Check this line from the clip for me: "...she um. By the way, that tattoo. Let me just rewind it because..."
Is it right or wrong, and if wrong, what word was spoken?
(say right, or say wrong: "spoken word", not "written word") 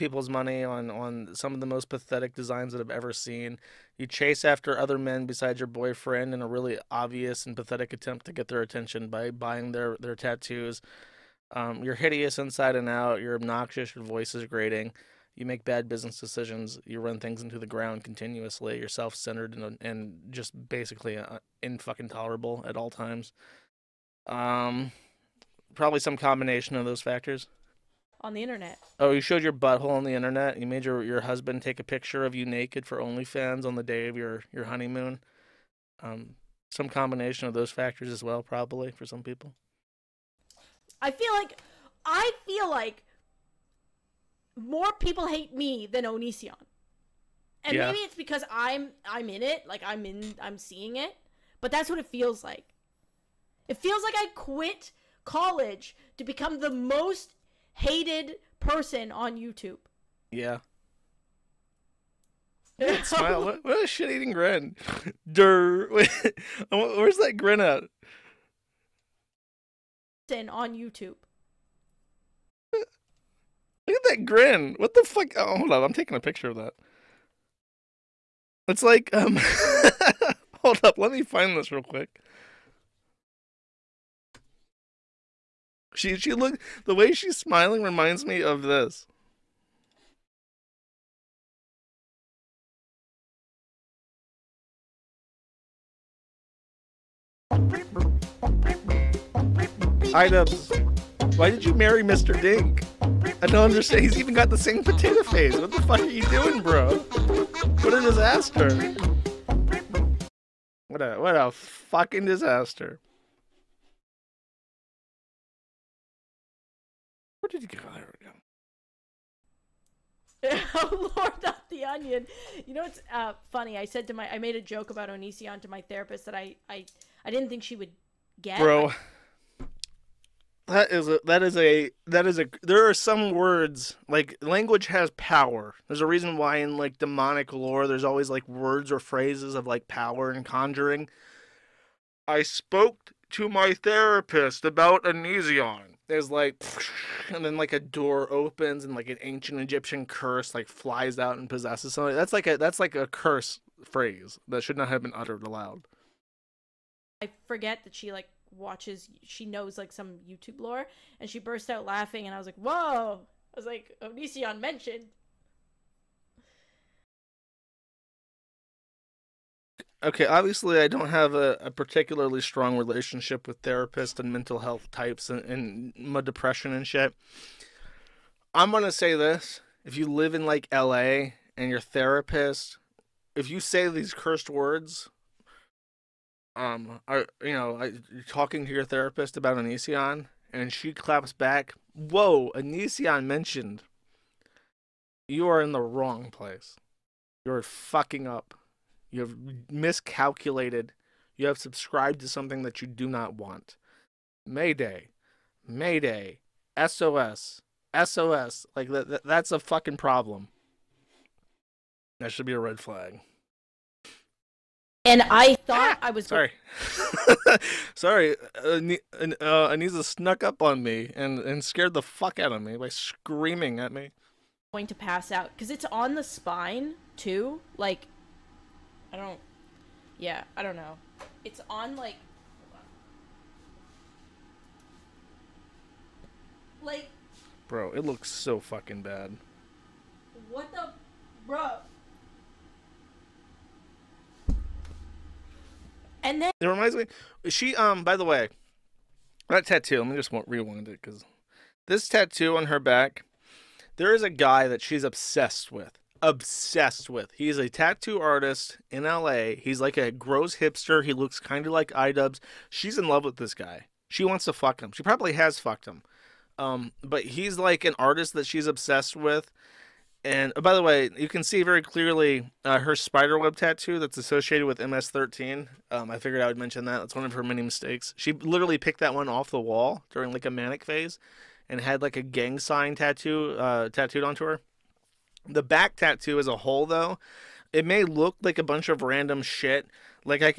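right.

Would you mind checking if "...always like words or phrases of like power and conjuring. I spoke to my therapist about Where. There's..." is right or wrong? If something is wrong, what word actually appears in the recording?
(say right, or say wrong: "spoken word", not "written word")
wrong: "Onision", not "Where".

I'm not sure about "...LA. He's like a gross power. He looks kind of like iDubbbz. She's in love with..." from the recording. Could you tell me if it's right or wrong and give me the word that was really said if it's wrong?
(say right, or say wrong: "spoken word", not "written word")
wrong: "hipster", not "power".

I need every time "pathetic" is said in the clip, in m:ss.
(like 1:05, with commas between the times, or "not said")
0:01, 0:07.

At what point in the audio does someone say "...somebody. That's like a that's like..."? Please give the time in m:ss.
2:31.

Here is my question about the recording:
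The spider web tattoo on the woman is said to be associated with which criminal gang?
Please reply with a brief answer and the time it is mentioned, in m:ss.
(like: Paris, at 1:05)
MS-13, at 4:34.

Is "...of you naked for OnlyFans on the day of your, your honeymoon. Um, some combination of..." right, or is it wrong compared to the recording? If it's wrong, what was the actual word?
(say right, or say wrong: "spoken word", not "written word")
right.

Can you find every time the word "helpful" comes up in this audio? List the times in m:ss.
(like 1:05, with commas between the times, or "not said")
not said.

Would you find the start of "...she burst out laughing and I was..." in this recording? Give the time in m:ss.
2:41.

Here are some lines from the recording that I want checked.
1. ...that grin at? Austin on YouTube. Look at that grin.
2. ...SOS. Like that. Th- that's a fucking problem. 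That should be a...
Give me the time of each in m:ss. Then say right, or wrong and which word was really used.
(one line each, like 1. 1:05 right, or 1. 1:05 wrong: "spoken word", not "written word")
1. 1:07 right
2. 3:27 right.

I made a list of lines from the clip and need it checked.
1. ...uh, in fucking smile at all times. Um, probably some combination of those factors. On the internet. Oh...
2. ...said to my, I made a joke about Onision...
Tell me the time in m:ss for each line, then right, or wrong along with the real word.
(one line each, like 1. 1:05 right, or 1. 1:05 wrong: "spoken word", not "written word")
1. 0:21 wrong: "tolerable", not "smile"
2. 2:03 right.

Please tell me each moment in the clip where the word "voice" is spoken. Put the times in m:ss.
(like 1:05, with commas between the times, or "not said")
0:14.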